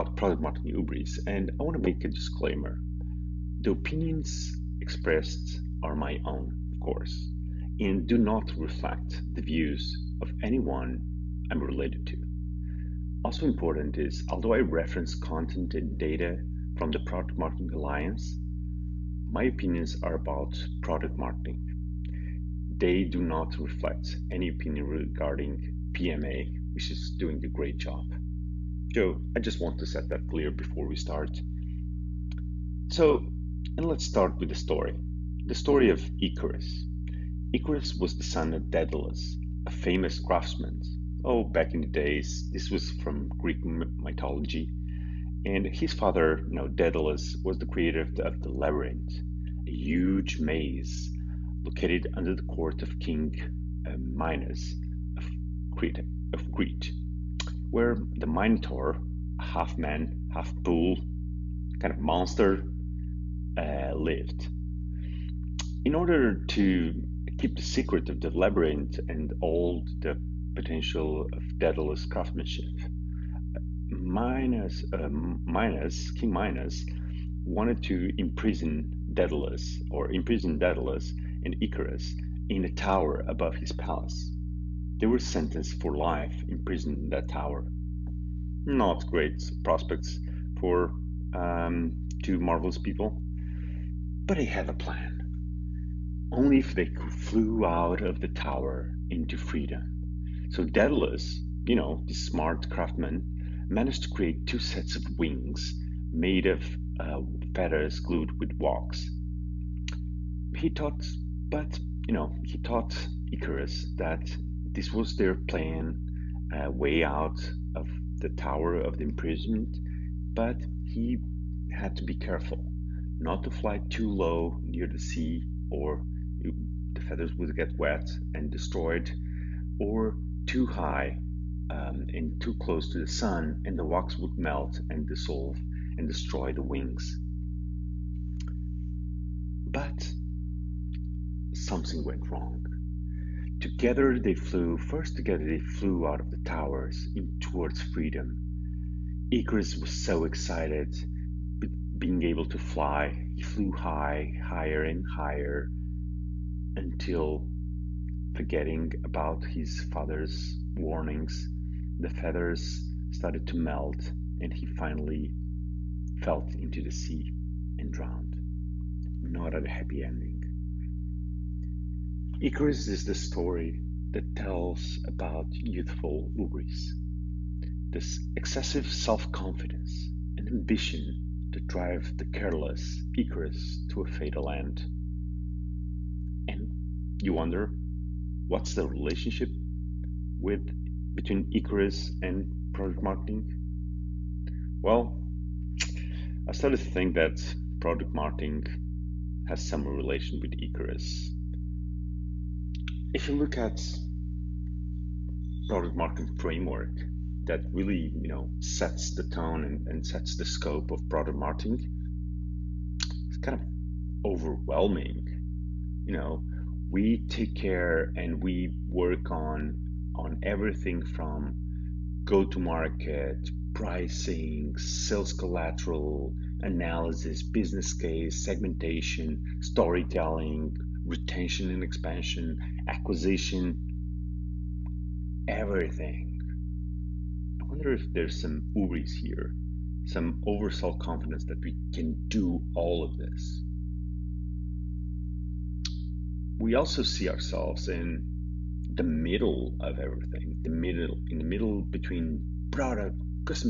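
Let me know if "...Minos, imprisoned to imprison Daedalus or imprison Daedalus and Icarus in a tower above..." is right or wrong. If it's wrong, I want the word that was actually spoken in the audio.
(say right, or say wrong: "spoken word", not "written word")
wrong: "wanted", not "imprisoned".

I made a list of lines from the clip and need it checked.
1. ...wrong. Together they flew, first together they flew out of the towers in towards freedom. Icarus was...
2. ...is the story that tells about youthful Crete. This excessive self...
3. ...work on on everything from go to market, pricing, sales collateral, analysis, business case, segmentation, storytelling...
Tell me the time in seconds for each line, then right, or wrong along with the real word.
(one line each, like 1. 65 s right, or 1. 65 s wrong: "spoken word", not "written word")
1. 142 s right
2. 172 s wrong: "Greece", not "Crete"
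3. 218 s right.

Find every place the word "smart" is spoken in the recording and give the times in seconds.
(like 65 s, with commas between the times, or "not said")
102 s.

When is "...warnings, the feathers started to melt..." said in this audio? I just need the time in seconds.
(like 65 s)
160 s.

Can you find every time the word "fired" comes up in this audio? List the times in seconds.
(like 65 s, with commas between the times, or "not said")
not said.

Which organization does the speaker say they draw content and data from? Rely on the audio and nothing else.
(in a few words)
Product Marketing Alliance.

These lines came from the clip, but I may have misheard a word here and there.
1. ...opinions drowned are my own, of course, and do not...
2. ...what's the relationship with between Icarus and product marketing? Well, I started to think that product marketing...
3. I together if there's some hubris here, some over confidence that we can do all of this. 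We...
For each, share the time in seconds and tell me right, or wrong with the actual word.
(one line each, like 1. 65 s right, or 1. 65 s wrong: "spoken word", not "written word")
1. 3 s wrong: "expressed", not "drowned"
2. 188 s right
3. 237 s wrong: "wonder", not "together".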